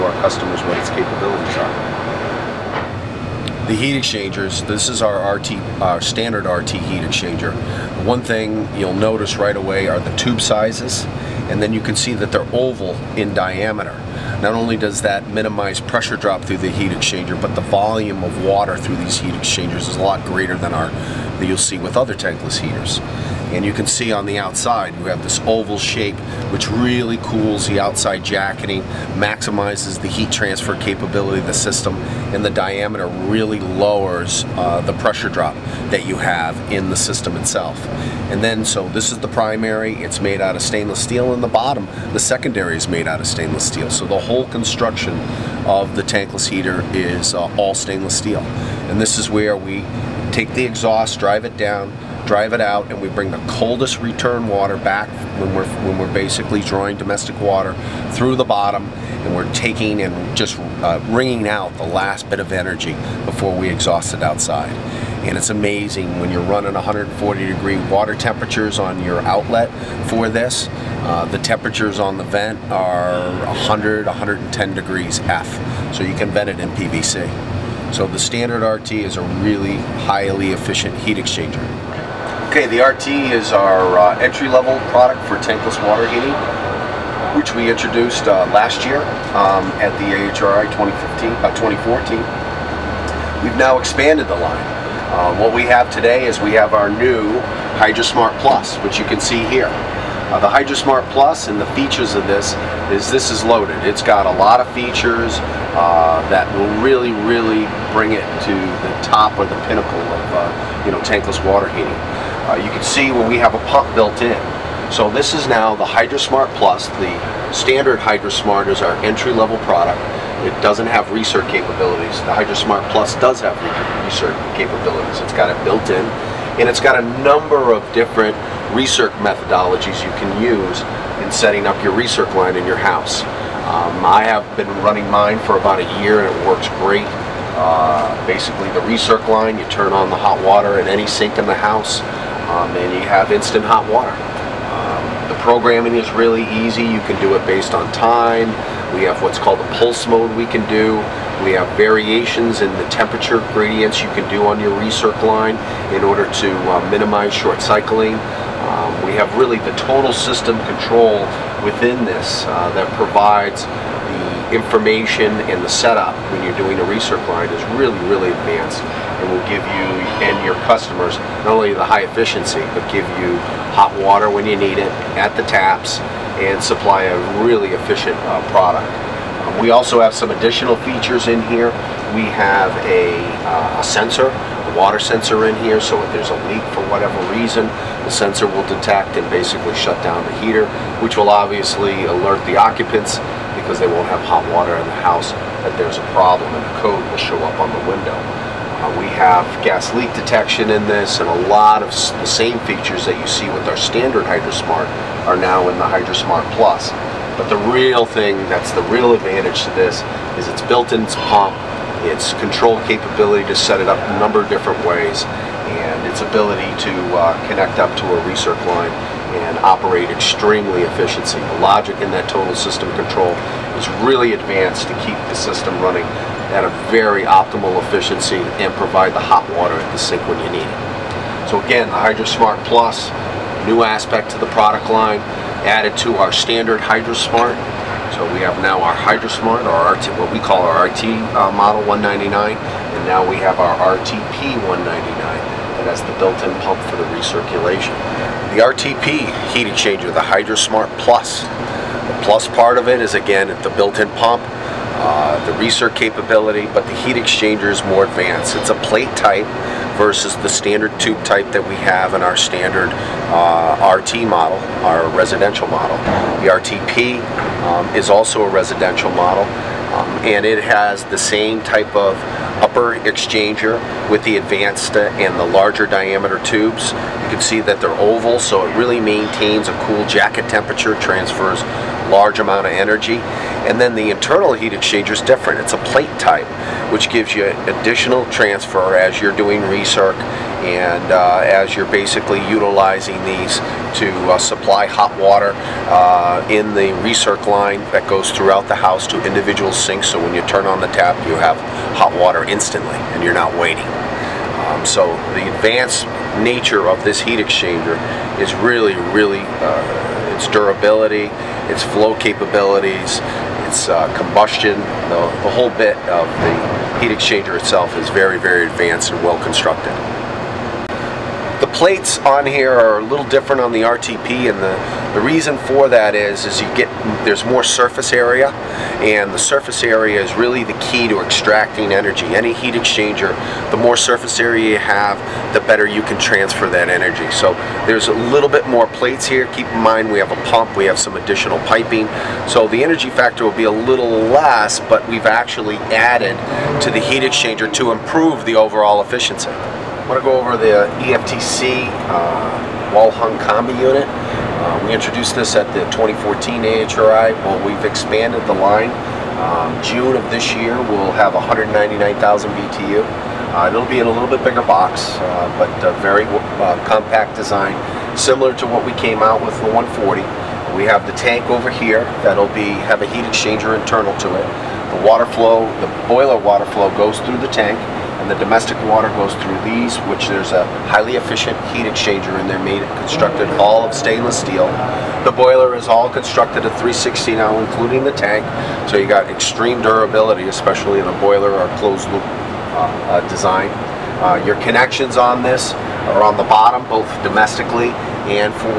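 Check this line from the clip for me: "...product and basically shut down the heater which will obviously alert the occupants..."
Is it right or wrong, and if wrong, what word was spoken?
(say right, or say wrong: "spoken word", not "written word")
wrong: "detect", not "product".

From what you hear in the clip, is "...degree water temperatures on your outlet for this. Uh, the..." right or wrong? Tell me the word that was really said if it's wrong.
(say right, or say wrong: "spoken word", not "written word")
right.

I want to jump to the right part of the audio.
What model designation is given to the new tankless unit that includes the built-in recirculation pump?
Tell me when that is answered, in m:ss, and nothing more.
4:03.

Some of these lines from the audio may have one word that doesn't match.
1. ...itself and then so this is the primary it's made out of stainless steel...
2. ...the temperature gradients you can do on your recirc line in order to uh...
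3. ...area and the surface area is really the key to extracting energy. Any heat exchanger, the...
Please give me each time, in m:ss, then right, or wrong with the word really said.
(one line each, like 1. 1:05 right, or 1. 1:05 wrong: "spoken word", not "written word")
1. 0:37 right
2. 2:32 right
3. 5:28 right.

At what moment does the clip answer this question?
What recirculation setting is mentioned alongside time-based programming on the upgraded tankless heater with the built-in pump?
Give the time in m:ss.
2:29.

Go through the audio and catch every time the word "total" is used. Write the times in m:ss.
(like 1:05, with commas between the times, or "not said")
2:39, 3:42.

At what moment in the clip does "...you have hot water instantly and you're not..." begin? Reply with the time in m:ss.
5:01.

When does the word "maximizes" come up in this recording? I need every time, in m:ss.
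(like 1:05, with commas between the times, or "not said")
0:29.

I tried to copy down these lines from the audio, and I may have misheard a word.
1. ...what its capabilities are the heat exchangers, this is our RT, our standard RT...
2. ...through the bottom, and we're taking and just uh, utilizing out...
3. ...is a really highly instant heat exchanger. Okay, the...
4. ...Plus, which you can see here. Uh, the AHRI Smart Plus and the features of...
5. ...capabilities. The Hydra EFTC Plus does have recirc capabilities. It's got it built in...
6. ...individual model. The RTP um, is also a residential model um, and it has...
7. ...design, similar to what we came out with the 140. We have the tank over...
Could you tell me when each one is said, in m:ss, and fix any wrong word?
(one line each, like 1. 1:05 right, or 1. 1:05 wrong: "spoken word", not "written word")
1. 0:00 right
2. 0:58 wrong: "wringing", not "utilizing"
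3. 1:18 wrong: "efficient", not "instant"
4. 1:38 wrong: "Hydra", not "AHRI"
5. 2:01 wrong: "Smart", not "EFTC"
6. 4:25 wrong: "residential", not "individual"
7. 6:07 right.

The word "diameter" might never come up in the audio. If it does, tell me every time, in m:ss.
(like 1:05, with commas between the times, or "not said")
0:13, 0:32, 4:35.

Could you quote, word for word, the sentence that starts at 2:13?
Um, I have been running mine for about a year and it works great.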